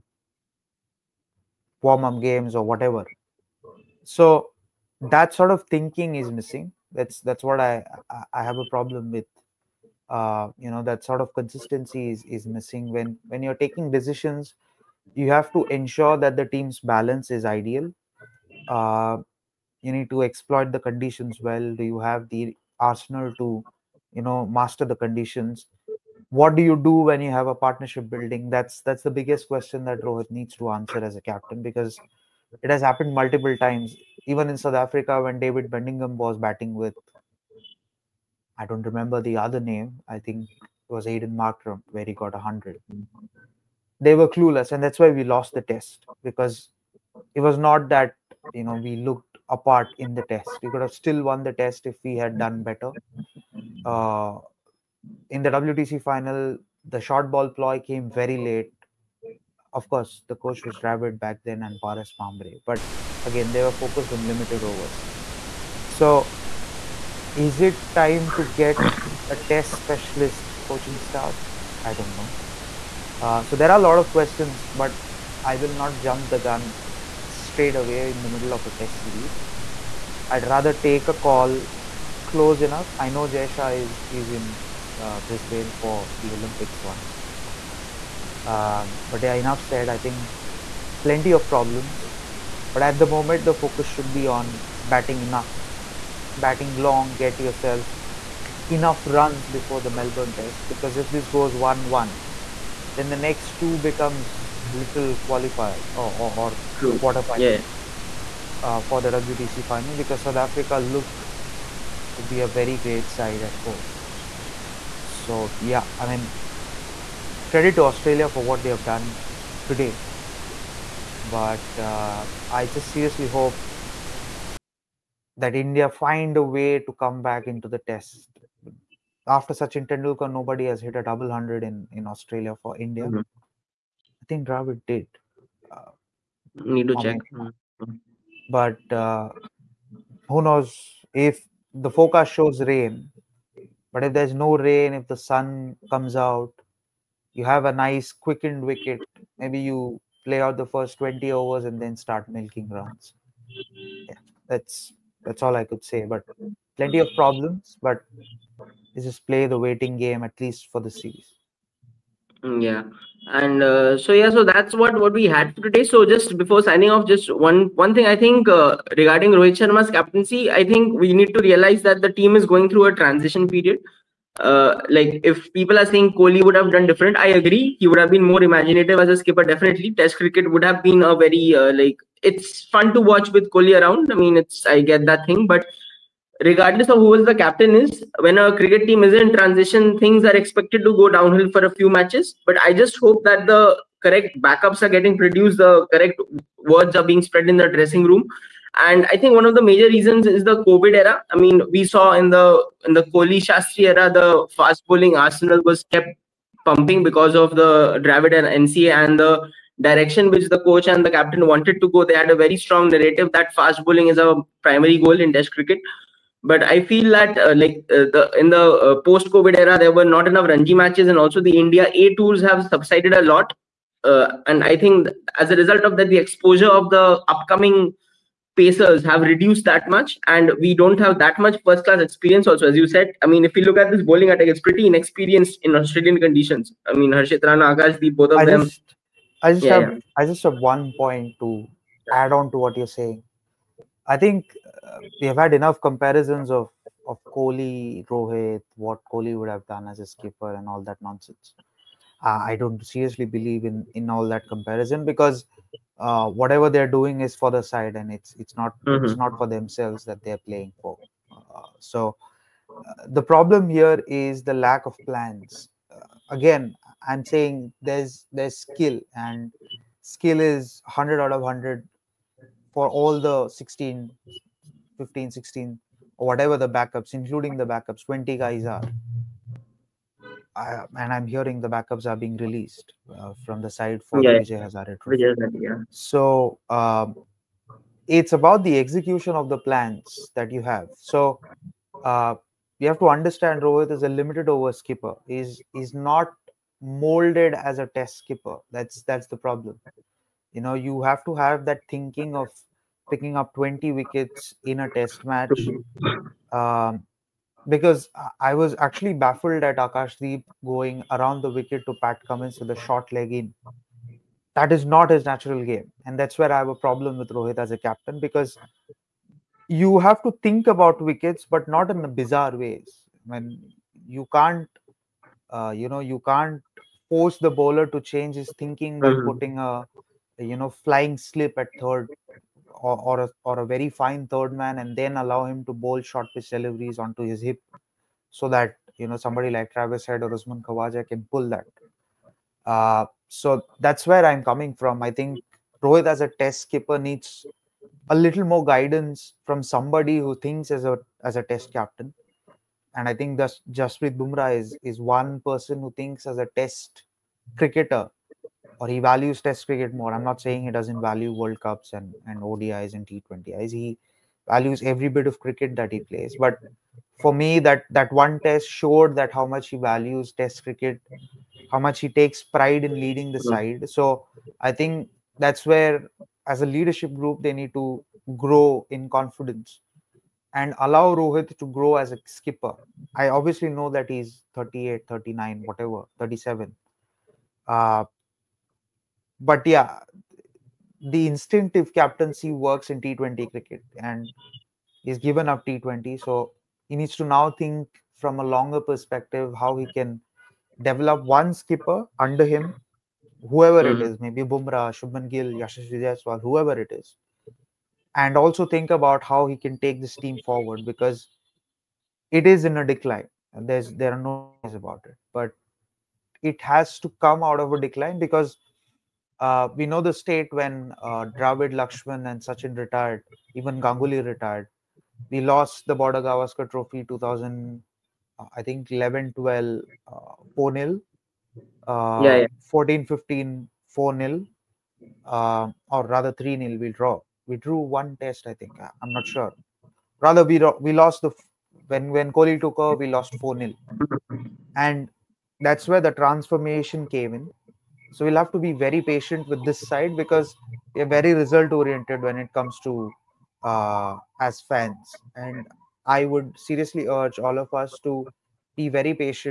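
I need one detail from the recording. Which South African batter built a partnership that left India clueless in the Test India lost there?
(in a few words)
David Bedingham.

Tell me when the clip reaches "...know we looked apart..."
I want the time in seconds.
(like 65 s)
48 s.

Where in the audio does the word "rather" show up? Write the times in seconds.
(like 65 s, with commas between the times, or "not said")
80 s, 436 s, 440 s.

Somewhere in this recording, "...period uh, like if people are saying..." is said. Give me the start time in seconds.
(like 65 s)
173 s.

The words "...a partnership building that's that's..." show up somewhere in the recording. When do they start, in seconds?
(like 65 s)
27 s.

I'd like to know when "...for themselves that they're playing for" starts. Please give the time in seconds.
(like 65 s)
259 s.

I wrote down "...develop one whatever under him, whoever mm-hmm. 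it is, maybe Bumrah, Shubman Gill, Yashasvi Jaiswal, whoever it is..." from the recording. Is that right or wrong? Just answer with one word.
wrong.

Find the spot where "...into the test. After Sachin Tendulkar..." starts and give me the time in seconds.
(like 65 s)
127 s.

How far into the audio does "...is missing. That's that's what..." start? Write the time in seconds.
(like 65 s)
6 s.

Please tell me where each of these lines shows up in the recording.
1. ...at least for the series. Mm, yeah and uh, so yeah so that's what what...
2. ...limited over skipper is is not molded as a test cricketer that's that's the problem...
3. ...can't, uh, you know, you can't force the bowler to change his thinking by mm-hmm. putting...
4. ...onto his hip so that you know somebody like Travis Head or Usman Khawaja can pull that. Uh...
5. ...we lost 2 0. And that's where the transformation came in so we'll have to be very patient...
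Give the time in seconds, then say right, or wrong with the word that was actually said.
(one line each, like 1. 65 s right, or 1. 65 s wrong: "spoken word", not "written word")
1. 160 s right
2. 294 s wrong: "skipper", not "cricketer"
3. 324 s right
4. 336 s right
5. 442 s wrong: "4", not "2".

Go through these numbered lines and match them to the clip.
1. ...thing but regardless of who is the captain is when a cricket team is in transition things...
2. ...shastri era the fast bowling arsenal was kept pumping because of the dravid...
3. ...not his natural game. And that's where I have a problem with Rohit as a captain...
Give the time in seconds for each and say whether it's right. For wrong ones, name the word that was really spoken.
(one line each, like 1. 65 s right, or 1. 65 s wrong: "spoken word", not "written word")
1. 185 s right
2. 203 s right
3. 314 s right.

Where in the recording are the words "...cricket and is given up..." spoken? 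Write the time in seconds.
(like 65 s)
393 s.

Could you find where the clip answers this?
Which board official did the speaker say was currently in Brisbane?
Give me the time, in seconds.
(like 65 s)
83 s.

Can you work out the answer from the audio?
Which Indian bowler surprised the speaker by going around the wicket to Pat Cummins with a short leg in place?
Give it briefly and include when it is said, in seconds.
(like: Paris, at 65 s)
Akashdeep, at 309 s.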